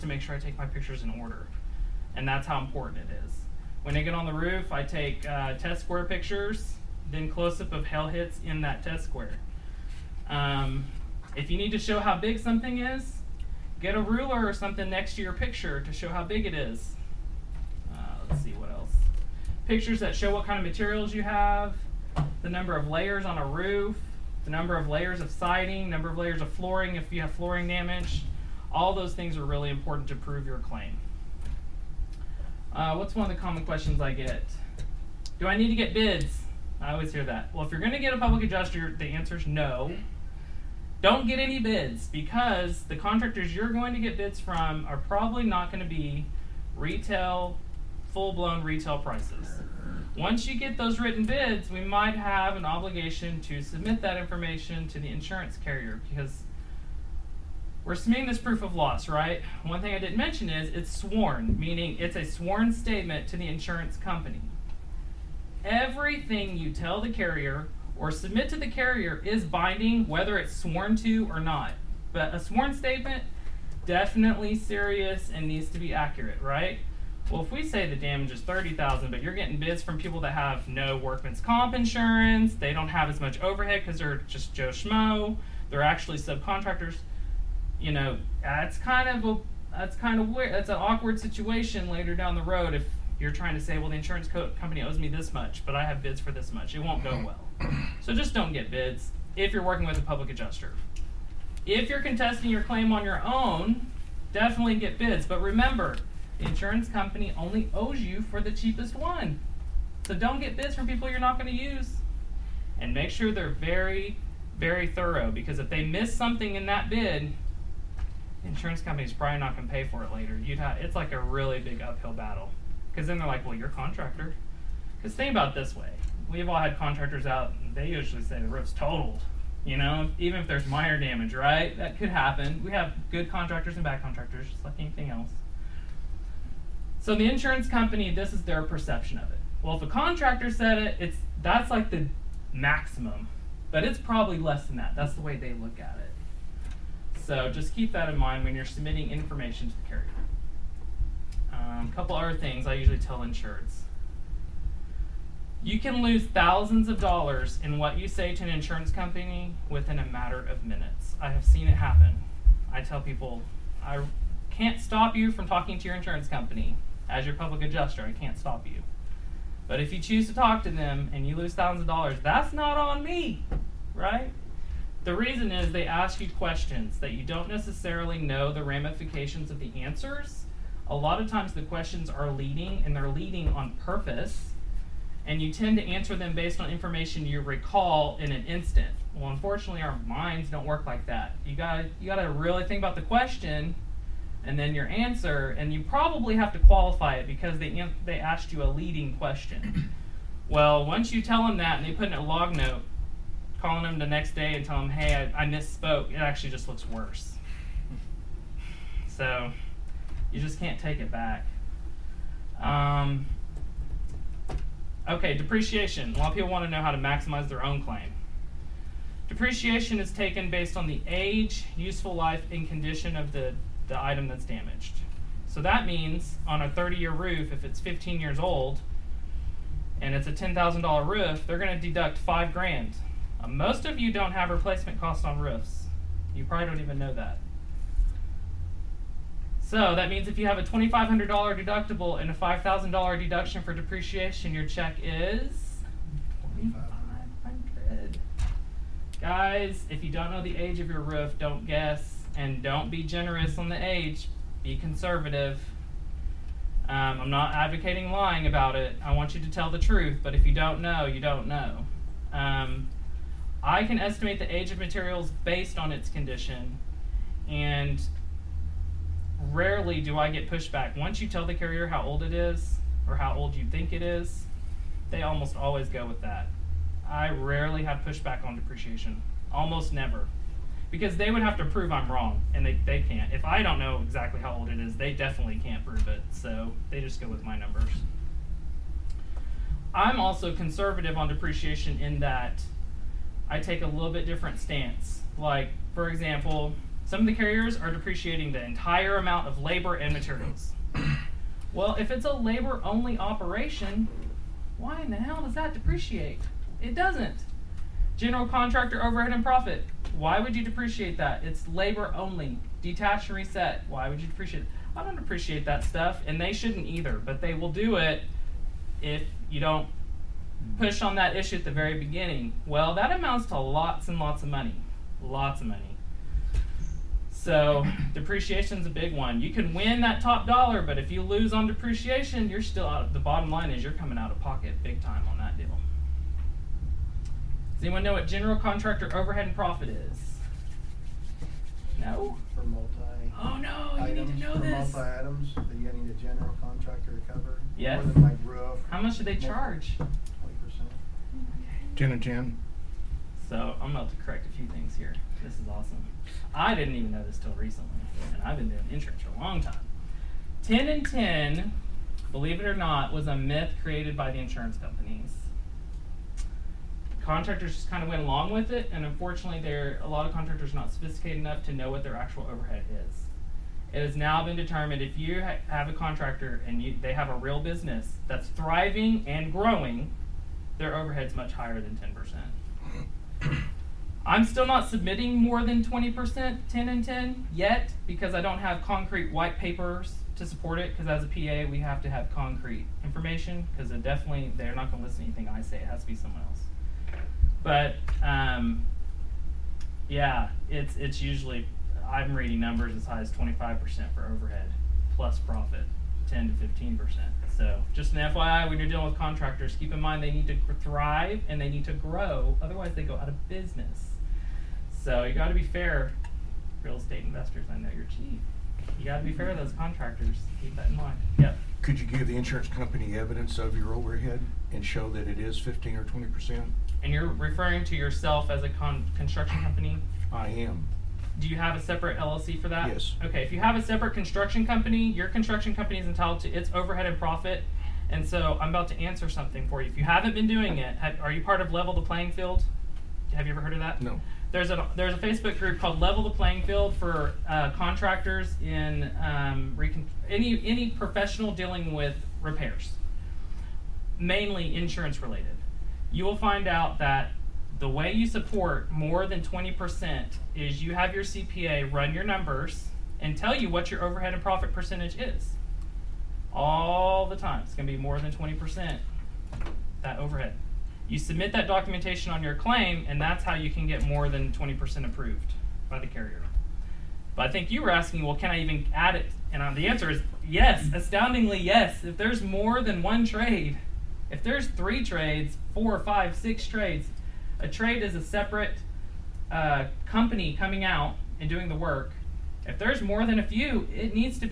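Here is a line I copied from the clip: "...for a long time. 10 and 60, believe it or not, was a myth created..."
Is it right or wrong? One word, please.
wrong.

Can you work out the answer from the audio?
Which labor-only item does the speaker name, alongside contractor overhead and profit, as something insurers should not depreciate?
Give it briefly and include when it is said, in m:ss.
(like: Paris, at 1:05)
Detach and reset, at 5:12.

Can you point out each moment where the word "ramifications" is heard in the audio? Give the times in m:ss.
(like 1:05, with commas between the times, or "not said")
2:58.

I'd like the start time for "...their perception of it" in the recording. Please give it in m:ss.
2:18.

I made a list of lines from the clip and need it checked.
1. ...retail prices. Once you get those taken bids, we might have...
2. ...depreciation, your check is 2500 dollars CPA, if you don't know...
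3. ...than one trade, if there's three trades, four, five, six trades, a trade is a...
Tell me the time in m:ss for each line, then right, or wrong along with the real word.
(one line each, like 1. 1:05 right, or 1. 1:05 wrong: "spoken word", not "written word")
1. 0:48 wrong: "written", not "taken"
2. 4:03 wrong: "Guys", not "CPA"
3. 8:02 right.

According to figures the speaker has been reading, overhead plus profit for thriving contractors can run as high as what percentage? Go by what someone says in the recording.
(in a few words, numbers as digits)
25%.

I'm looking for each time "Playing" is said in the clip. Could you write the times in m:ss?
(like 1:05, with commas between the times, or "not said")
7:22, 7:26.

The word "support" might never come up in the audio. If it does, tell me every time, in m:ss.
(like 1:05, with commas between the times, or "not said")
6:30, 7:38.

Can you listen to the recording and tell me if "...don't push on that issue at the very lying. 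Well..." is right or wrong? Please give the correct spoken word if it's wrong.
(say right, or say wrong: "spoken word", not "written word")
wrong: "beginning", not "lying".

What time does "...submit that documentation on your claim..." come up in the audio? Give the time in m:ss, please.
7:51.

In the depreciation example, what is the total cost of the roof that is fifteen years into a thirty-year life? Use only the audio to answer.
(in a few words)
$10,000.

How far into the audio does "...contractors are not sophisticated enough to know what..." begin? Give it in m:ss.
6:10.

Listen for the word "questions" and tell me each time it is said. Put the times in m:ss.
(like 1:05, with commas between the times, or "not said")
0:33, 2:56, 3:01, 3:13, 3:19.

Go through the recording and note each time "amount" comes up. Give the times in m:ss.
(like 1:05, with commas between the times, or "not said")
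4:59, 5:23.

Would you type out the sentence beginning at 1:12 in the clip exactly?
But a sworn statement, definitely serious and needs to be accurate, right?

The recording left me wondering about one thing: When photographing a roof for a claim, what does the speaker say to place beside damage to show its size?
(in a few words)
a ruler.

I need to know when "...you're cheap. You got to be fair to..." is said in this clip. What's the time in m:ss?
6:57.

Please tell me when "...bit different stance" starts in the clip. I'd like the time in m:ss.
4:54.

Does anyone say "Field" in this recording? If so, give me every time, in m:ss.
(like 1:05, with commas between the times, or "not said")
7:22, 7:26.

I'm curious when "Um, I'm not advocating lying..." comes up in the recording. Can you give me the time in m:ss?
4:16.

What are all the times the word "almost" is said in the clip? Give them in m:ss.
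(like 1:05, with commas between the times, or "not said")
4:35, 4:39.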